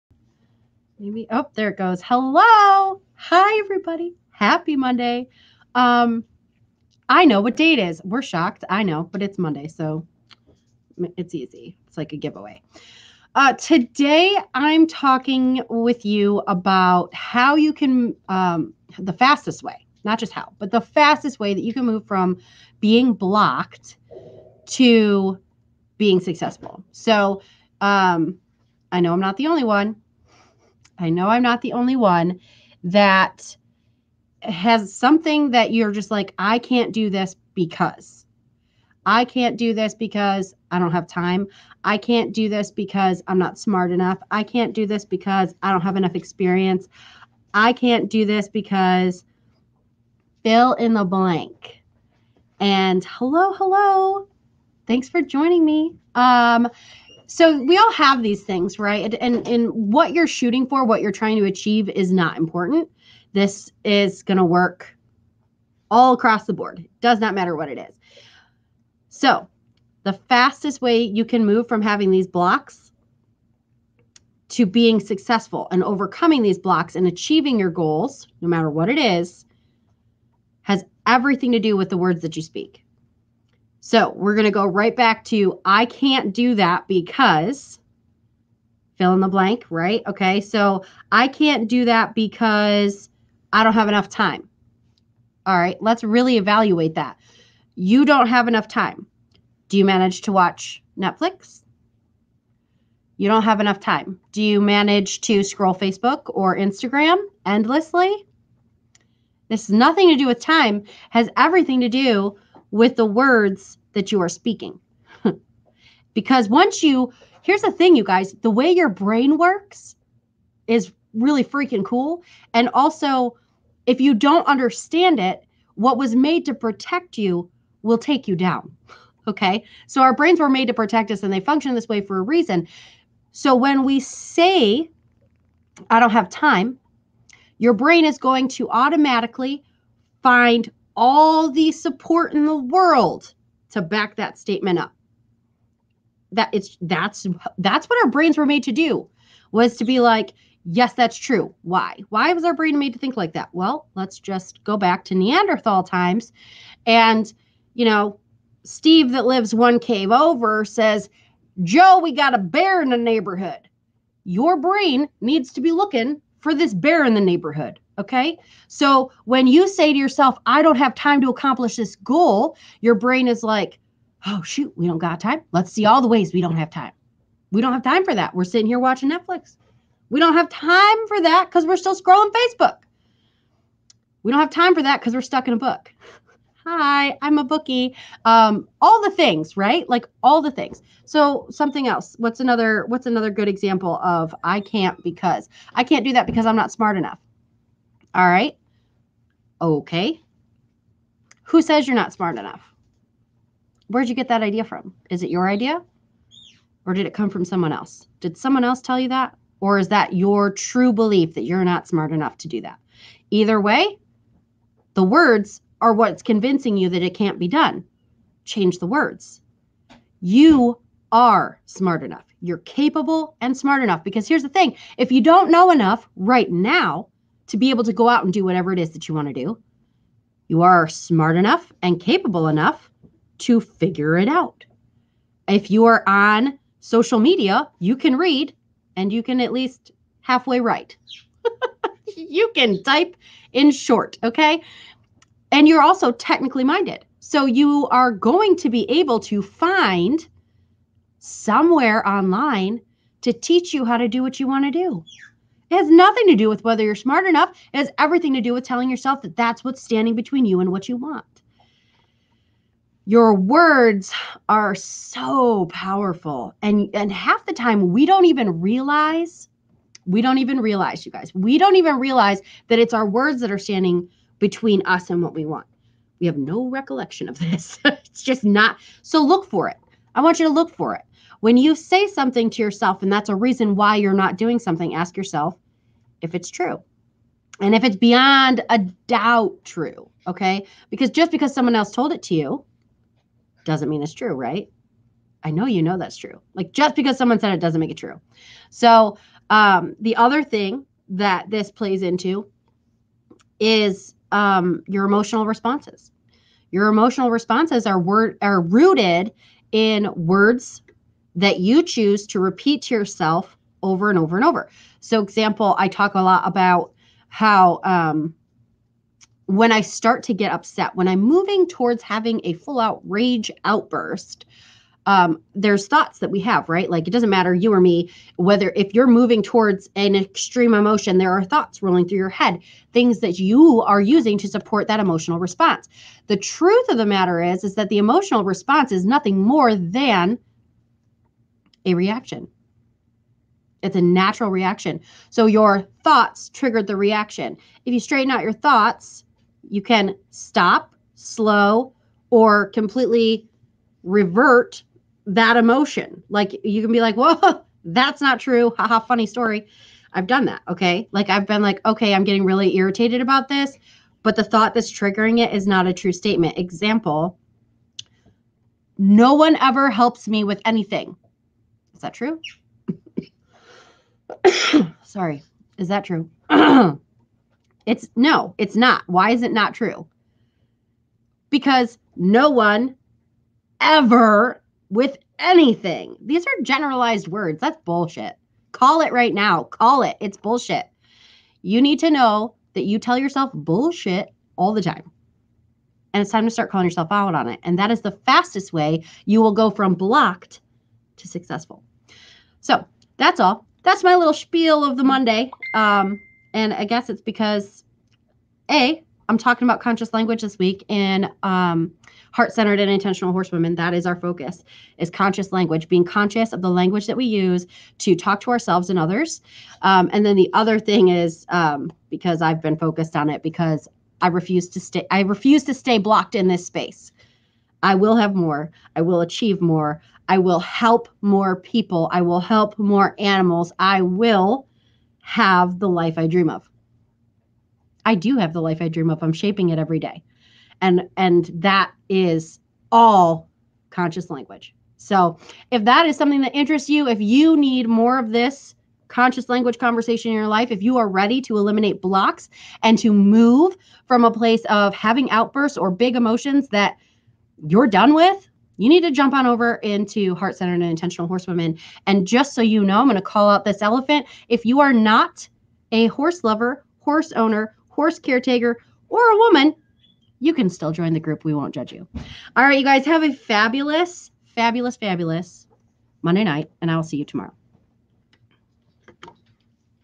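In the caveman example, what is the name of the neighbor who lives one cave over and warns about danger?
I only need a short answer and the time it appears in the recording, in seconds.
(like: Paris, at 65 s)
Steve, at 158 s.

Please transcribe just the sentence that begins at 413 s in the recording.
That is our focus: is conscious language, being conscious of the language that we use to talk to ourselves and others.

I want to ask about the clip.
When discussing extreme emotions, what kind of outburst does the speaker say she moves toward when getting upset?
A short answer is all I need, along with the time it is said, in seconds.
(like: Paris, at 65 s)
rage outburst, at 323 s.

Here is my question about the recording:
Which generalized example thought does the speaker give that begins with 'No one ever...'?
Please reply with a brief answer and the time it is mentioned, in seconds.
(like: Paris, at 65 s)
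helps me with anything, at 369 s.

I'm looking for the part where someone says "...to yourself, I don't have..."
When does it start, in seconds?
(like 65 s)
169 s.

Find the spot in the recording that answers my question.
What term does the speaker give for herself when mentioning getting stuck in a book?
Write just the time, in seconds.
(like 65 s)
187 s.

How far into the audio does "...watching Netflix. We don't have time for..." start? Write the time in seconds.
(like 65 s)
178 s.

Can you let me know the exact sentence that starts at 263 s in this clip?
Your words are so powerful and and half the time we don't even realize we don't even realize you guys.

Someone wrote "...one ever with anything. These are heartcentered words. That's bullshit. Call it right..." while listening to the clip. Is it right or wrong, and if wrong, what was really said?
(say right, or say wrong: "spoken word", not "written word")
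wrong: "generalized", not "heartcentered".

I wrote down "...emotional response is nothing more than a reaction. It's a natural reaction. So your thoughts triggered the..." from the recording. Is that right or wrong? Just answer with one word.
right.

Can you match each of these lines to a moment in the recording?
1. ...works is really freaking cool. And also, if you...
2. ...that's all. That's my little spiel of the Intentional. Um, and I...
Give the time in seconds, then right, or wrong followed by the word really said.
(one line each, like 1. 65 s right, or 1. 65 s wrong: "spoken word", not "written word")
1. 119 s right
2. 403 s wrong: "Monday", not "Intentional".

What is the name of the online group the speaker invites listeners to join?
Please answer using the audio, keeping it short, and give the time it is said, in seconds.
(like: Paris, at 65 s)
Heart Centered and Intentional Horsewomen, at 460 s.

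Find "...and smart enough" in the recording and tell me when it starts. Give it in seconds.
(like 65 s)
223 s.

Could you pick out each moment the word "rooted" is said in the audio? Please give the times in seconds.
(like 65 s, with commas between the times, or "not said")
308 s.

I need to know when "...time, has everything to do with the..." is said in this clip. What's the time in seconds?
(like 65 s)
110 s.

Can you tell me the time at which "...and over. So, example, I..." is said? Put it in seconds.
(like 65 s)
314 s.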